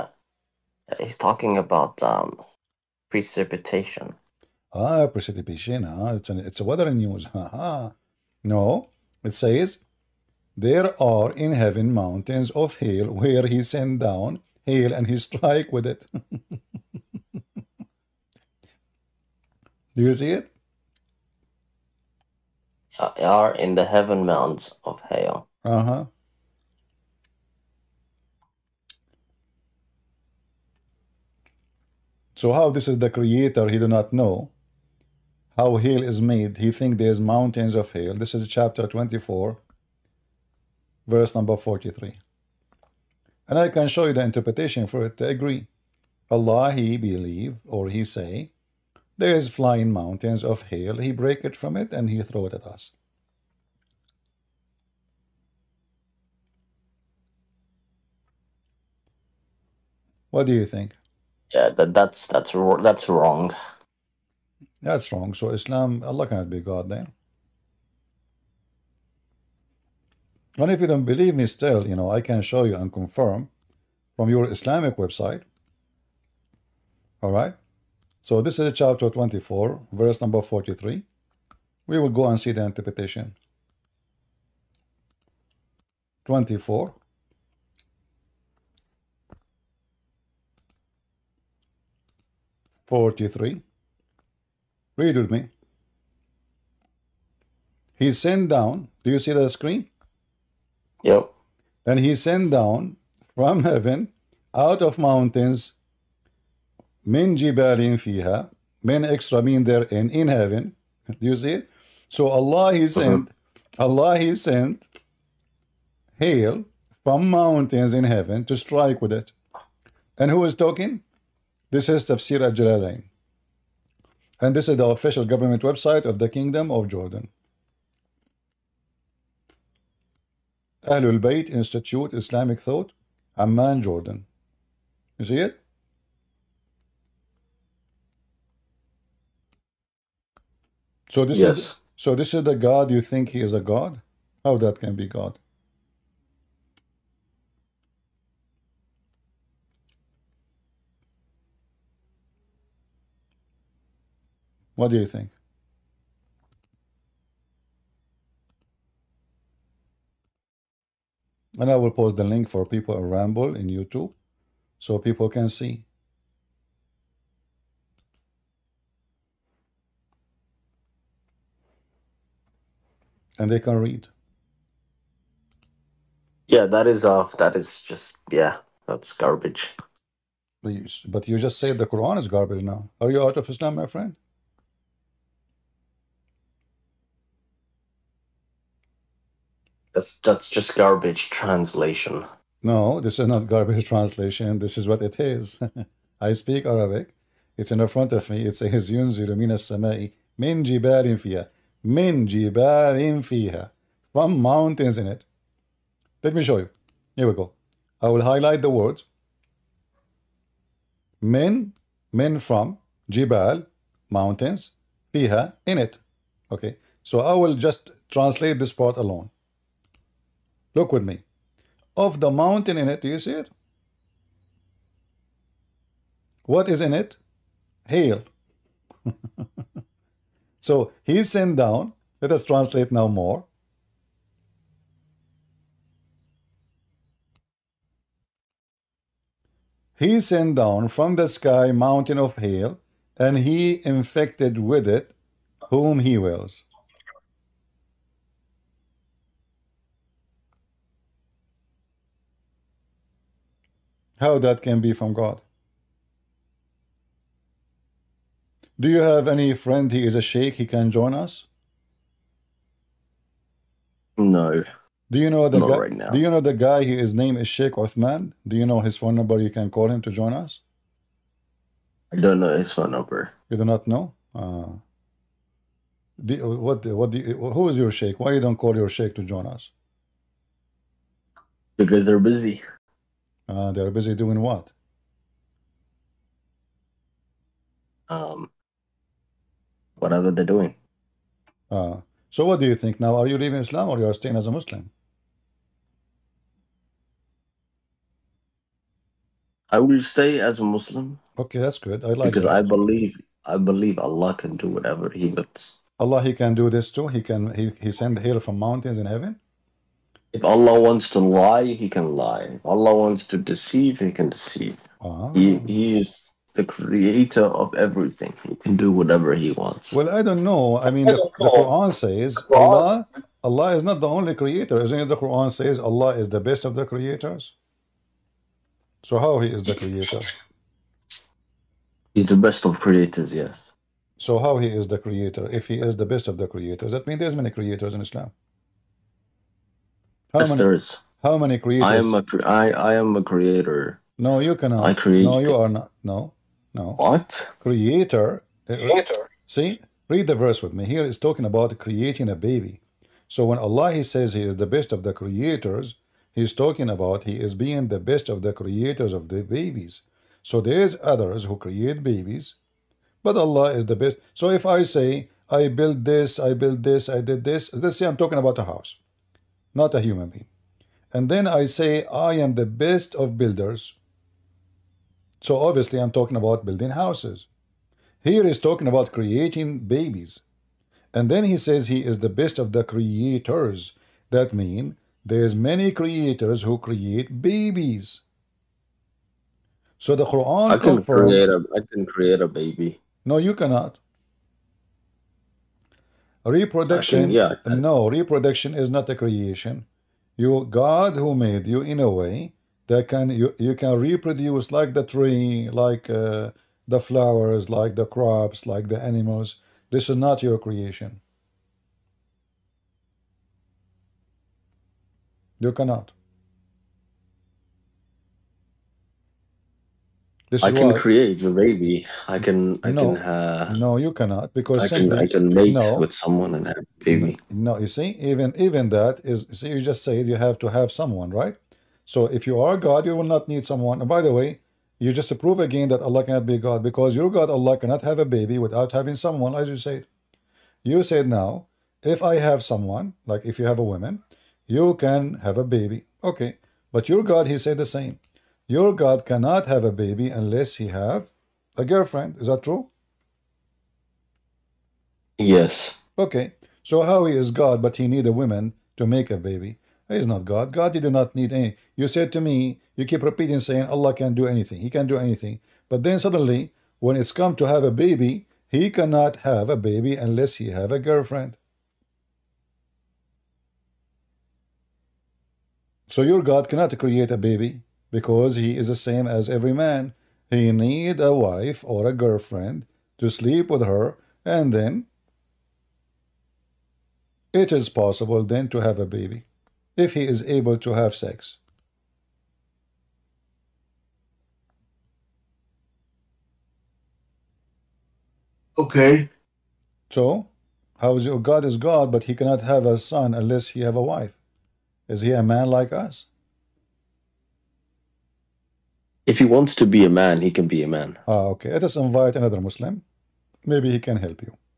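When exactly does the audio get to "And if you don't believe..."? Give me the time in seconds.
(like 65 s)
70 s.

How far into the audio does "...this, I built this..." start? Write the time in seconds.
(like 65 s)
366 s.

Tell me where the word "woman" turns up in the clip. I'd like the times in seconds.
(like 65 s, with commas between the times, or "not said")
443 s, 458 s.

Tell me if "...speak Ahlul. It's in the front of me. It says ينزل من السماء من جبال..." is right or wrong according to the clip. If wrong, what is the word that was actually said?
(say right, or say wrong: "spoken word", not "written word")
wrong: "Arabic", not "Ahlul".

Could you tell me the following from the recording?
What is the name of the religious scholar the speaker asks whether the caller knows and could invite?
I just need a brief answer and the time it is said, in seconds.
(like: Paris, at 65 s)
Sheikh Othman, at 267 s.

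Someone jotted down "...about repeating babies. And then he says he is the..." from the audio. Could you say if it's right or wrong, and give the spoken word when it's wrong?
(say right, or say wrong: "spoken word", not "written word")
wrong: "creating", not "repeating".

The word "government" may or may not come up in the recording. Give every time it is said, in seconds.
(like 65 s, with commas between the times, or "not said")
125 s.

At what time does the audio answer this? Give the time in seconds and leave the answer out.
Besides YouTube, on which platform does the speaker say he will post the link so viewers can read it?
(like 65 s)
163 s.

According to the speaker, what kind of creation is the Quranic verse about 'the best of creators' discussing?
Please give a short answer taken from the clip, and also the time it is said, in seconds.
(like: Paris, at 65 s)
creating a baby, at 351 s.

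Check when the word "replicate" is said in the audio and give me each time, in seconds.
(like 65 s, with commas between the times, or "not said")
not said.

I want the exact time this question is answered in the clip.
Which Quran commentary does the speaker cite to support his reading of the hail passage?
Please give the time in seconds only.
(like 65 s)
122 s.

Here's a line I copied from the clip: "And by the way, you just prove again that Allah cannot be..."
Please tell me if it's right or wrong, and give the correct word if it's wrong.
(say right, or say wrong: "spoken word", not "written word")
right.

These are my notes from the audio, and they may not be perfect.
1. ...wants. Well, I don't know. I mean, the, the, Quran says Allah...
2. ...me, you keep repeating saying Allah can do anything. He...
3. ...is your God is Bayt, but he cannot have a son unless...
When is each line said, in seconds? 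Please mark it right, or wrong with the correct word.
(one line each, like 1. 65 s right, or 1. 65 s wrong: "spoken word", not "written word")
1. 319 s right
2. 462 s right
3. 501 s wrong: "God", not "Bayt".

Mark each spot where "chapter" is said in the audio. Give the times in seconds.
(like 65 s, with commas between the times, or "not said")
38 s, 78 s.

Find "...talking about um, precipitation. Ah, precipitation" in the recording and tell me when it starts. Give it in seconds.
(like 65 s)
1 s.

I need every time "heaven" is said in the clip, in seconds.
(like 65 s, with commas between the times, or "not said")
11 s, 23 s, 103 s, 110 s, 118 s, 309 s.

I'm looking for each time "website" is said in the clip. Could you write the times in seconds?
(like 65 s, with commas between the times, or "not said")
74 s, 125 s.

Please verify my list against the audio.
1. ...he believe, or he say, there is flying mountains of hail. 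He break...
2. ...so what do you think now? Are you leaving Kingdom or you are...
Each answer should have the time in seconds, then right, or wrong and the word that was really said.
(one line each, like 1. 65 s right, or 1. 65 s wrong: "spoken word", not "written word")
1. 46 s right
2. 292 s wrong: "Islam", not "Kingdom".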